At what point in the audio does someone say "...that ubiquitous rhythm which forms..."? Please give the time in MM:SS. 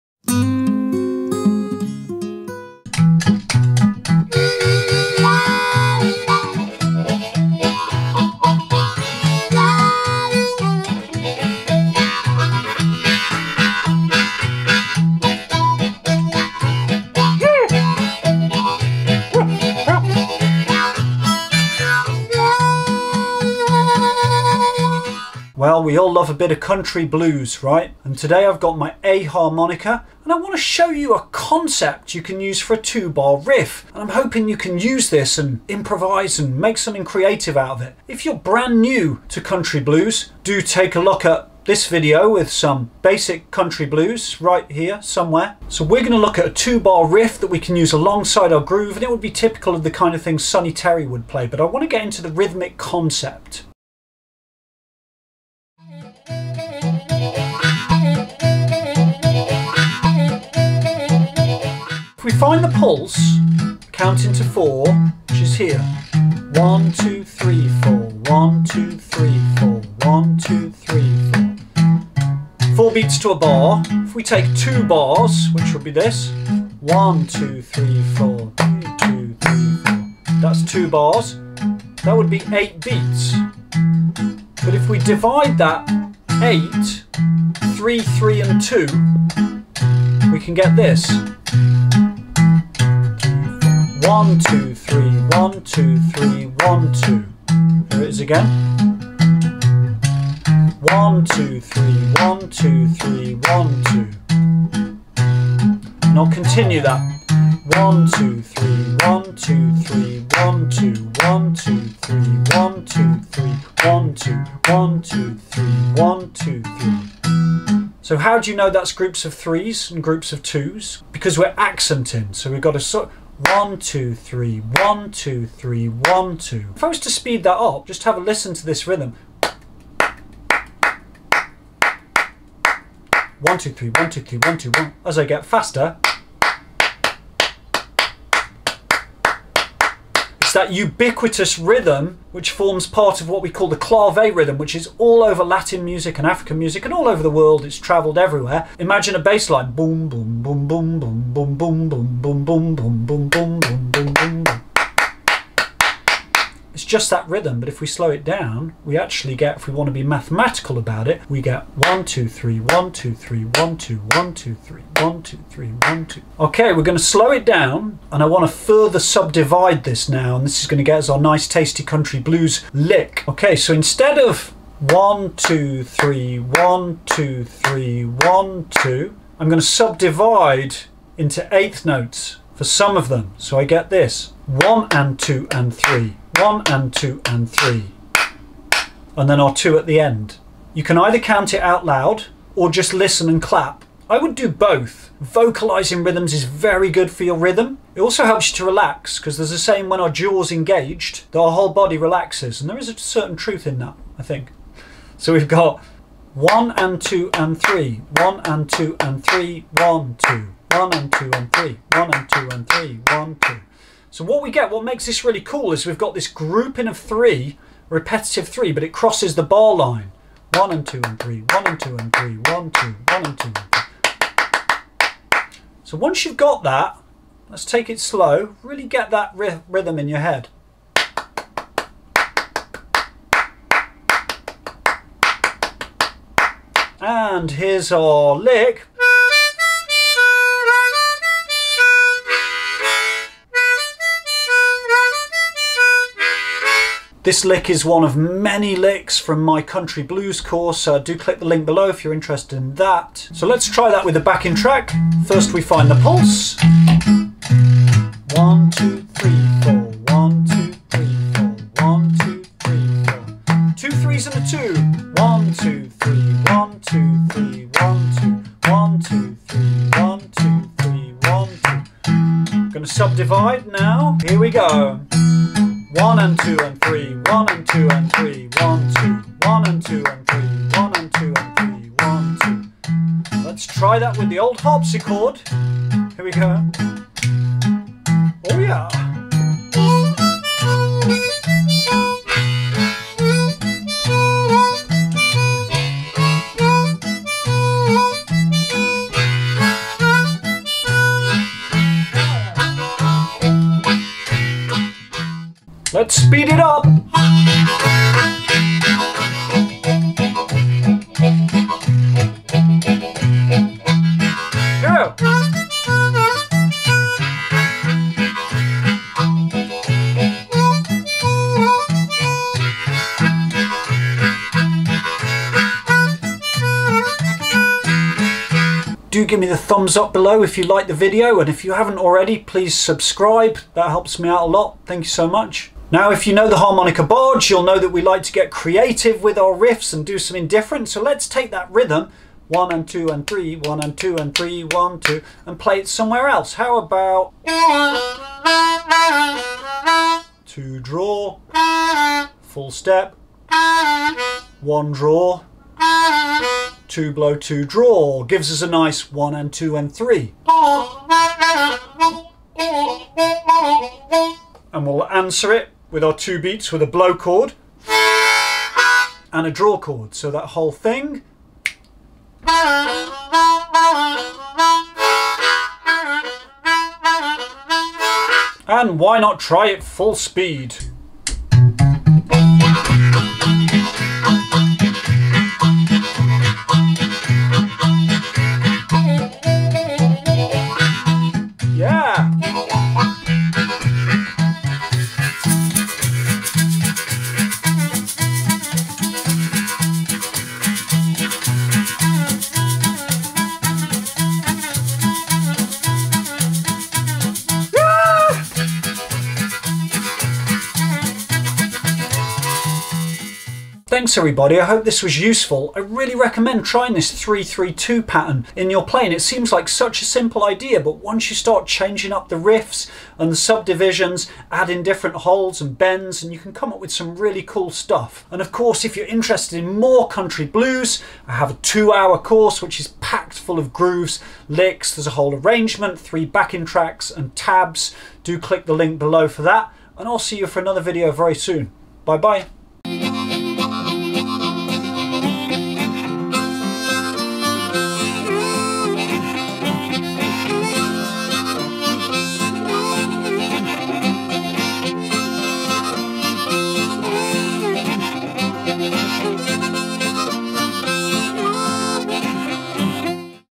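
02:20.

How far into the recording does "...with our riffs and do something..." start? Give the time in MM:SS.
05:39.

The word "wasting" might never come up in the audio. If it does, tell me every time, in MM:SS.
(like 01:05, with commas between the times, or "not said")
not said.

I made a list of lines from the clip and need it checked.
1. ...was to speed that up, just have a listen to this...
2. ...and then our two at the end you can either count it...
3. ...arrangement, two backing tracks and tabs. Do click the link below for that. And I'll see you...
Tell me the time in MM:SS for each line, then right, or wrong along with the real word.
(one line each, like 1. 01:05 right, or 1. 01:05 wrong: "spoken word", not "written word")
1. 02:06 right
2. 03:09 right
3. 07:15 wrong: "three", not "two".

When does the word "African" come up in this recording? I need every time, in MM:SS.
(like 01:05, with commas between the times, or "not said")
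02:26.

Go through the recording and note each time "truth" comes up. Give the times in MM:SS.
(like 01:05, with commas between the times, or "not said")
03:23.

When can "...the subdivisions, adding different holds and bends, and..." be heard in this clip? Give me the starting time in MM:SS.
07:03.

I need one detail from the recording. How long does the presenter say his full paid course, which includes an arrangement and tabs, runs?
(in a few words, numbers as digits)
2 hours.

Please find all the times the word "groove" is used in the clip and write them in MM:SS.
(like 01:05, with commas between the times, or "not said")
00:48, 07:13.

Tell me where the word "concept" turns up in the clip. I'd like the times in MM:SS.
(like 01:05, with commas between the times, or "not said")
00:31, 00:52.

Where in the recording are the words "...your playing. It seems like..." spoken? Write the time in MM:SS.
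06:58.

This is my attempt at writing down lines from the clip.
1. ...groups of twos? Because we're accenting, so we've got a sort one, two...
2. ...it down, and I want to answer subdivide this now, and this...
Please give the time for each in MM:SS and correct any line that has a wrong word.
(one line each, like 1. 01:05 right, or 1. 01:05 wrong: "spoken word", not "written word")
1. 02:00 right
2. 02:47 wrong: "further", not "answer".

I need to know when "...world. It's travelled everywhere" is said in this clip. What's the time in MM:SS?
02:27.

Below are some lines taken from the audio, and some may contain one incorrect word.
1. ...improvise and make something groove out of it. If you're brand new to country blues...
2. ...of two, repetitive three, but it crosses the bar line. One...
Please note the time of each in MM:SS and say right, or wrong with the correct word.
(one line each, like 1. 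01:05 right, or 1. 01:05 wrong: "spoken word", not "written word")
1. 00:35 wrong: "creative", not "groove"
2. 03:36 wrong: "three", not "two".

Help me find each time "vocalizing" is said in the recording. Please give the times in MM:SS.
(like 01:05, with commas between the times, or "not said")
03:15.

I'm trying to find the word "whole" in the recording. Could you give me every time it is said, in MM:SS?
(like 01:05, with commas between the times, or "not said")
03:21, 06:10, 07:15.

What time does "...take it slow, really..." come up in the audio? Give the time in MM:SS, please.
03:47.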